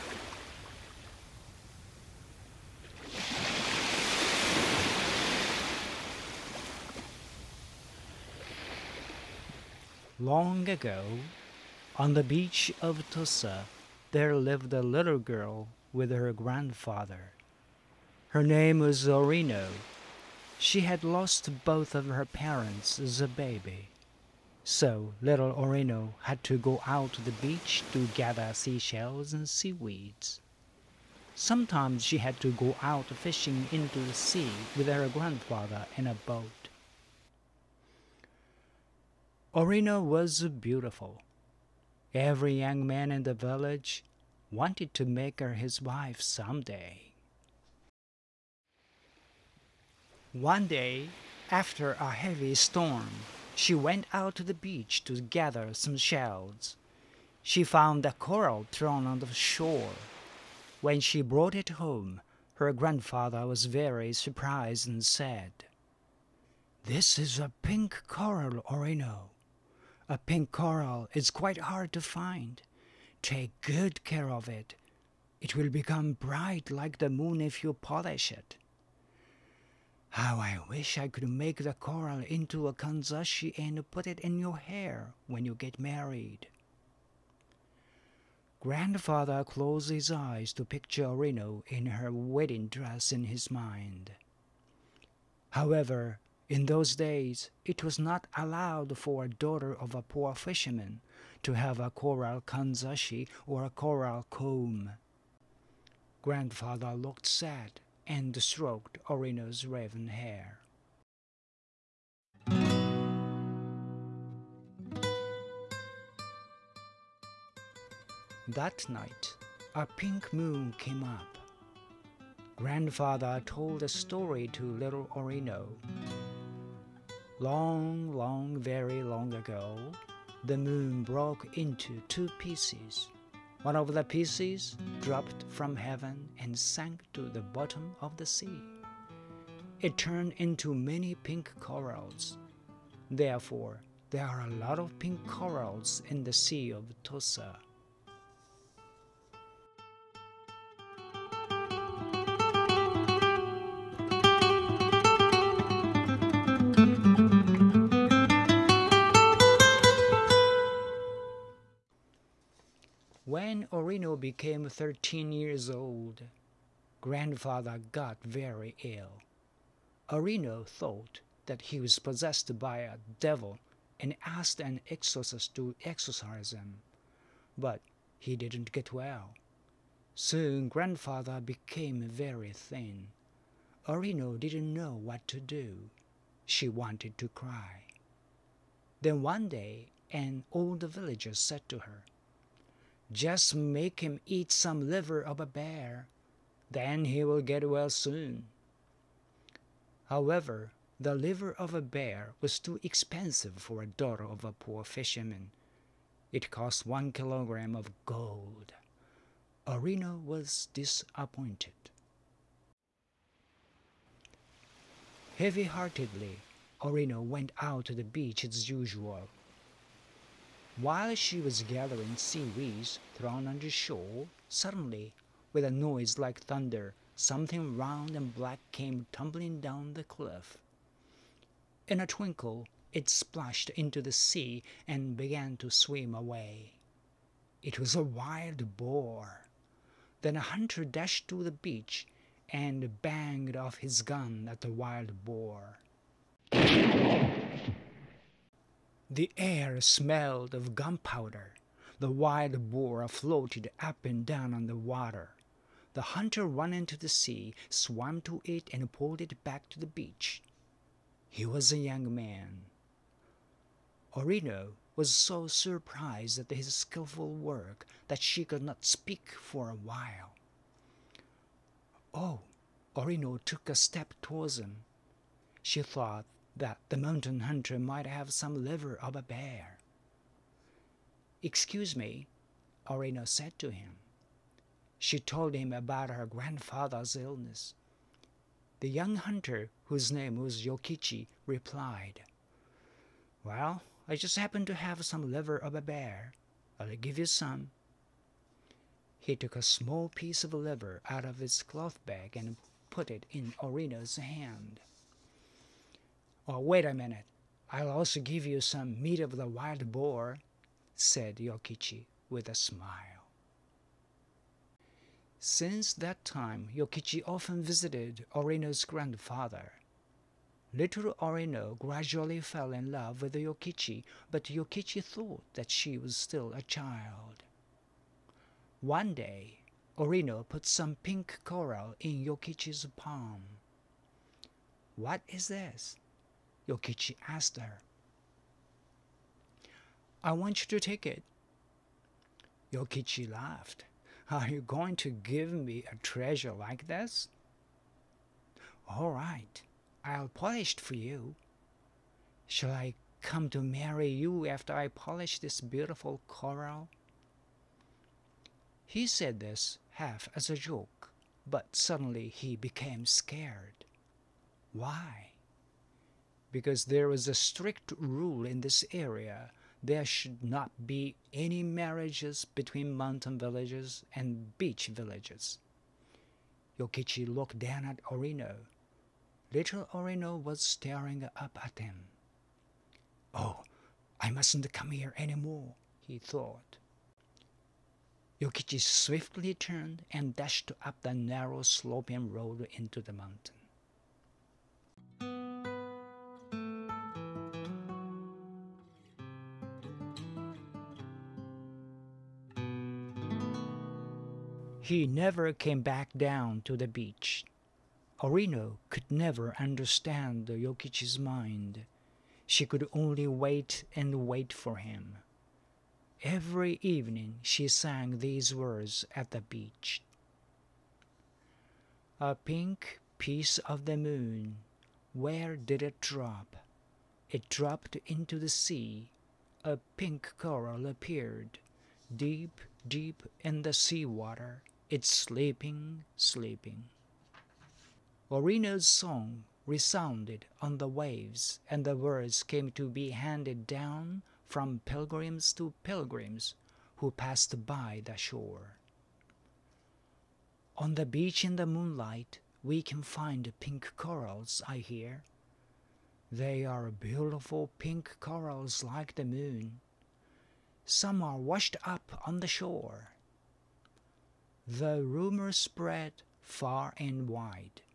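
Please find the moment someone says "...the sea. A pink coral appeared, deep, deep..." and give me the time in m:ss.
7:08.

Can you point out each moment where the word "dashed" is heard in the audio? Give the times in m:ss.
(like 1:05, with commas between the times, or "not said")
4:00, 6:30.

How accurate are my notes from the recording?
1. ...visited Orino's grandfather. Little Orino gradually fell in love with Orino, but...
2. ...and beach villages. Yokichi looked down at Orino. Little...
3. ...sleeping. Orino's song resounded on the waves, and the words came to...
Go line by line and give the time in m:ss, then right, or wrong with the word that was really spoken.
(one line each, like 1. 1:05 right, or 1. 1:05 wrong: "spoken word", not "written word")
1. 5:17 wrong: "Yokichi", not "Orino"
2. 6:14 right
3. 7:16 right.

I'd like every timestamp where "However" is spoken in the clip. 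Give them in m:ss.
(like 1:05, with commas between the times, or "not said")
1:35, 3:20.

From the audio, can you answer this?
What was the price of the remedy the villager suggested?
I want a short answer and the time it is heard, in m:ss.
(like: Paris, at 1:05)
1 kilogram of gold, at 3:26.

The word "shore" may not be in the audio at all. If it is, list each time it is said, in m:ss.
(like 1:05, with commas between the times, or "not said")
0:59, 3:43, 7:28, 7:42.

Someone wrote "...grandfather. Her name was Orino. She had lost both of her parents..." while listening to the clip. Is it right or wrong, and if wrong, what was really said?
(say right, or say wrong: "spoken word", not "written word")
right.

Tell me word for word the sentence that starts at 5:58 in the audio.
He said this half as a joke, but suddenly he became scared.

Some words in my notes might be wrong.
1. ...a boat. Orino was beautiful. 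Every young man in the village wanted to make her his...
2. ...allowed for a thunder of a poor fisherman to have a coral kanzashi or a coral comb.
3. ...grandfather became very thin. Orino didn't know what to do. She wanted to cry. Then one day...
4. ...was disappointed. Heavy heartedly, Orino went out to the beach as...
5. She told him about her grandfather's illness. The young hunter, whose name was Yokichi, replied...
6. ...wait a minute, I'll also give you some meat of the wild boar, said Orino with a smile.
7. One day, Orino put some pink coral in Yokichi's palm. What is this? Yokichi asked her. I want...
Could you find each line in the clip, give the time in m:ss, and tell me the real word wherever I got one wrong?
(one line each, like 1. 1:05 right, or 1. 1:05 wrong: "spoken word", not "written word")
1. 0:36 right
2. 1:38 wrong: "daughter", not "thunder"
3. 3:00 right
4. 3:30 right
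5. 4:44 right
6. 5:06 wrong: "Yokichi", not "Orino"
7. 5:28 right.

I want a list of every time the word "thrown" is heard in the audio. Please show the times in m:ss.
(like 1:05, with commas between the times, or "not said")
0:58, 3:43.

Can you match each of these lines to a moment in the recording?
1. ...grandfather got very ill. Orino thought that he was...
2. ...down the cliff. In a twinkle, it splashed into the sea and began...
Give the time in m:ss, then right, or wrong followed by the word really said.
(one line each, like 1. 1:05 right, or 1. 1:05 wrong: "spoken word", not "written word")
1. 2:47 right
2. 3:49 right.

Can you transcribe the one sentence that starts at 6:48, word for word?
Orino could never understand Yokichi's mind.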